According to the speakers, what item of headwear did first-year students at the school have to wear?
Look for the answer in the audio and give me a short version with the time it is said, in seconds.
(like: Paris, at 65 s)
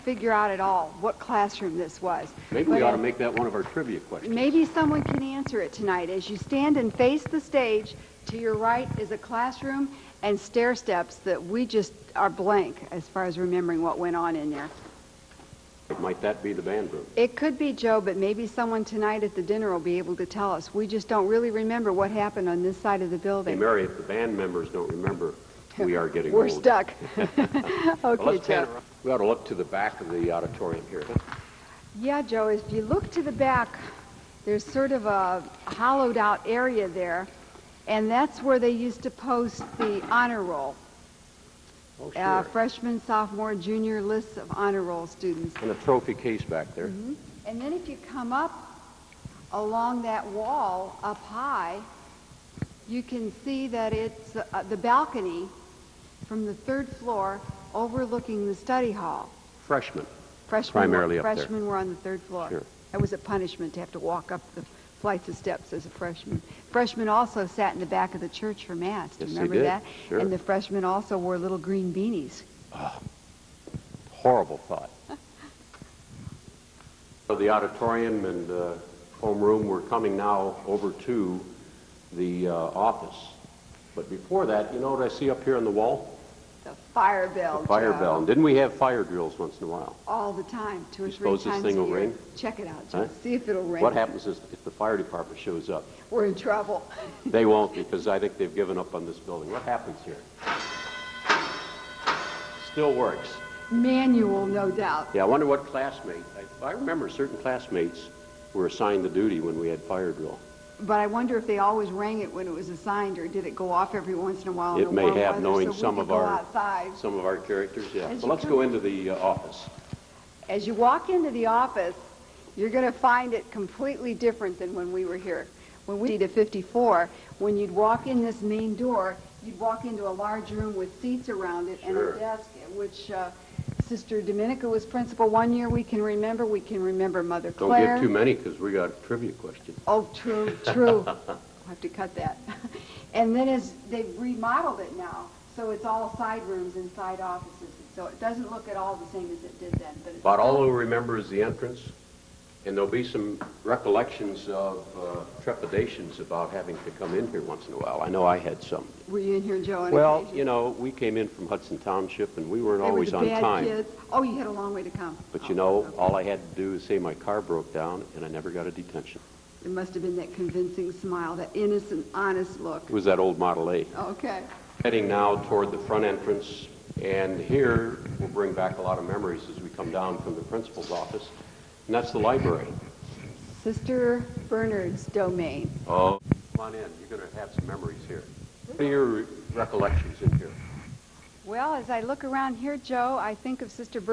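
little green beanies, at 71 s.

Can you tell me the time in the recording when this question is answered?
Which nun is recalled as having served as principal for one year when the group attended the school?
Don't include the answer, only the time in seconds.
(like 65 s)
133 s.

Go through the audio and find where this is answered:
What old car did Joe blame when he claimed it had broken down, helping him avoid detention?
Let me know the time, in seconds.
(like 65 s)
173 s.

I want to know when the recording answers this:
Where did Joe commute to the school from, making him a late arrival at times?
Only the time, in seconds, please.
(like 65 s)
161 s.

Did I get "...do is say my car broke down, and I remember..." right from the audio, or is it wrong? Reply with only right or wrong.
wrong.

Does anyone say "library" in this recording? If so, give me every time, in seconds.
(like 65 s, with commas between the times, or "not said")
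182 s.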